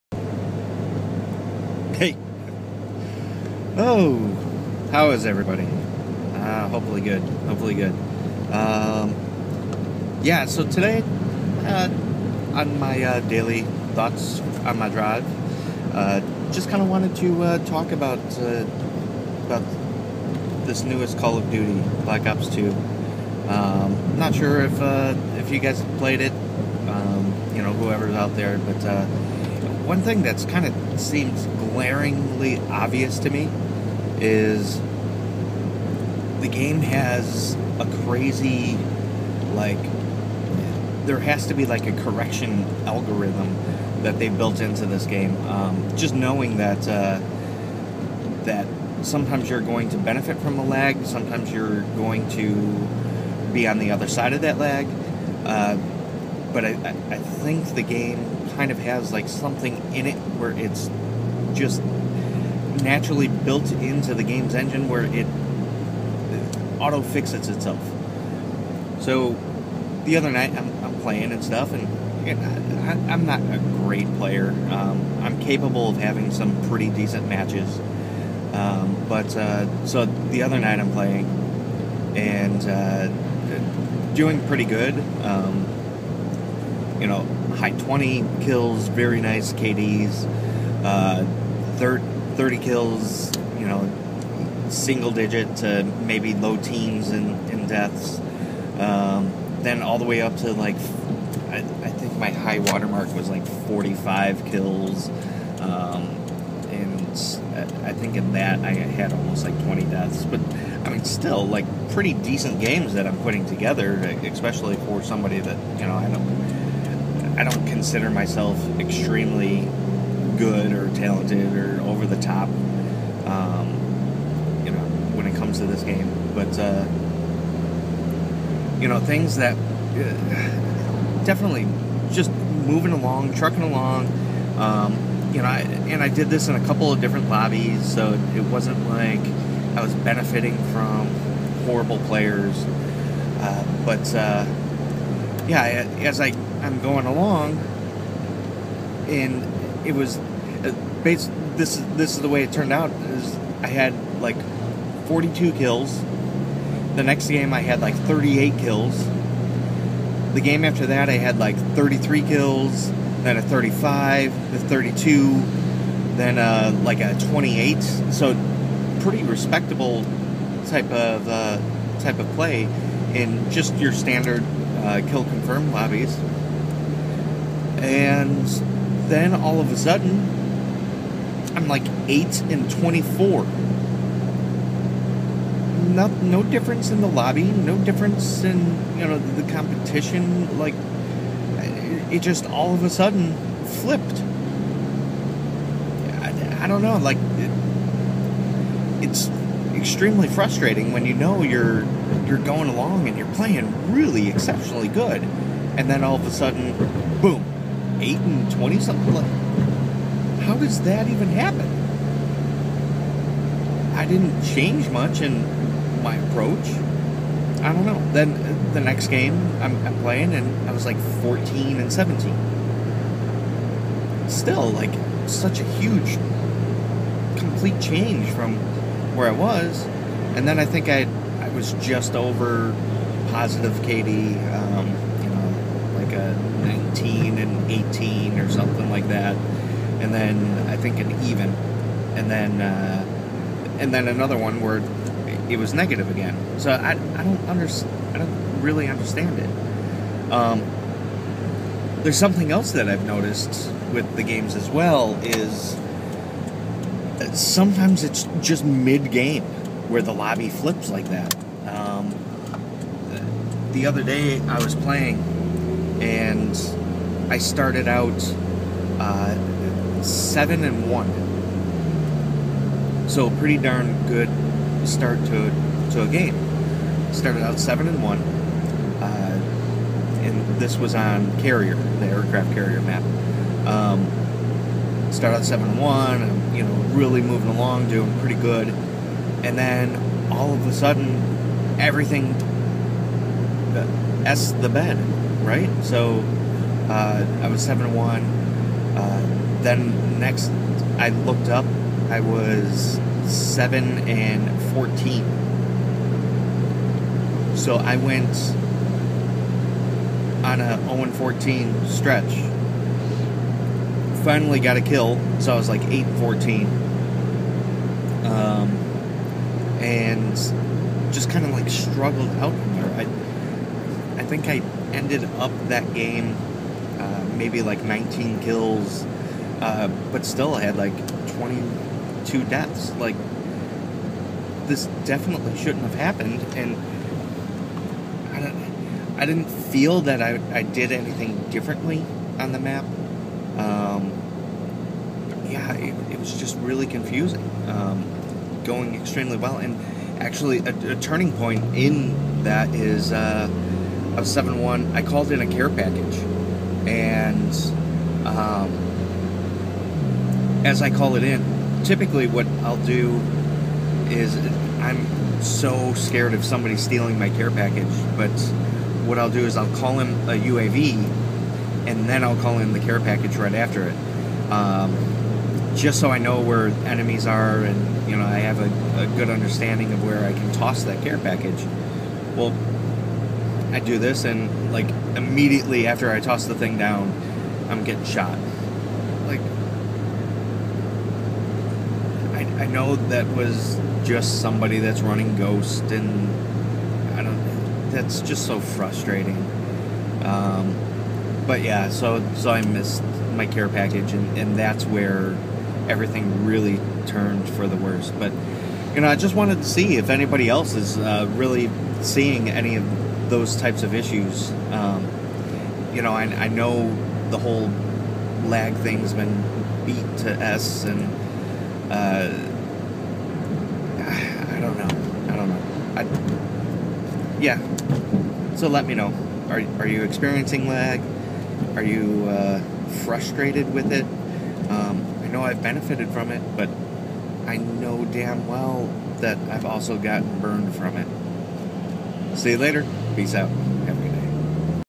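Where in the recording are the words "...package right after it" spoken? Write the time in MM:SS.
06:12.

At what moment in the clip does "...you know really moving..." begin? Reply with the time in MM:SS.
04:46.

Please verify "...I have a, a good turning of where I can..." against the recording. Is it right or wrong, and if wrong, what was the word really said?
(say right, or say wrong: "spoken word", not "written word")
wrong: "understanding", not "turning".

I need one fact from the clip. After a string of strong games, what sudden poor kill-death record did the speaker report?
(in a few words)
8 and 24.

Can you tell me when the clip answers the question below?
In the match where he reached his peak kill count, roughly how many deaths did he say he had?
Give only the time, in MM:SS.
01:49.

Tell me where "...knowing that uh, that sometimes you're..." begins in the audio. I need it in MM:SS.
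00:46.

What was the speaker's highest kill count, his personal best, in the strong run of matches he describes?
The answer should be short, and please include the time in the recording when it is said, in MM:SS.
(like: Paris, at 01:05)
45, at 01:43.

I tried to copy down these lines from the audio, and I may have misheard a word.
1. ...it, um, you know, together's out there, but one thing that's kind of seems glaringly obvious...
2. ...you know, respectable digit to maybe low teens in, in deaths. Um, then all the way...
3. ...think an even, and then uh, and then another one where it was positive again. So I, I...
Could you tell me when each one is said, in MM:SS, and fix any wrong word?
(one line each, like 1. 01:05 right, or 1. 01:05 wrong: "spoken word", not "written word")
1. 00:26 wrong: "whoever", not "together"
2. 01:33 wrong: "single", not "respectable"
3. 04:00 wrong: "negative", not "positive".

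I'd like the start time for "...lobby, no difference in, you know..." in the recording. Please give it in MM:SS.
03:07.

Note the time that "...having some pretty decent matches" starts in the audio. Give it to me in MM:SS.
01:15.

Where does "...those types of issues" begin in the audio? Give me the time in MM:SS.
06:53.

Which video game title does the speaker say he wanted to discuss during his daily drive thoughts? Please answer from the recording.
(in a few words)
Black Ops Two.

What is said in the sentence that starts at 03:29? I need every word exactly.
Like, how does that even happen?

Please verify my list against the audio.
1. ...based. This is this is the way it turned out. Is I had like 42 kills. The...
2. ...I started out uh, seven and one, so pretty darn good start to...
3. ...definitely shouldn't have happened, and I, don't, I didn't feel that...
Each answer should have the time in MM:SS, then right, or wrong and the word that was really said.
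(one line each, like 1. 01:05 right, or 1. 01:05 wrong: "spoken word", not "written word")
1. 02:31 right
2. 04:27 right
3. 05:35 right.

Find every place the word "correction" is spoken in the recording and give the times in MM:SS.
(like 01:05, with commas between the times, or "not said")
00:42.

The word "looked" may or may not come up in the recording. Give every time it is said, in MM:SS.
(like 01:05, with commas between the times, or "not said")
05:01.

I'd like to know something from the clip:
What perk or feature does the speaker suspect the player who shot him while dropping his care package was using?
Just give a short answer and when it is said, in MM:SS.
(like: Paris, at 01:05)
Ghost, at 06:35.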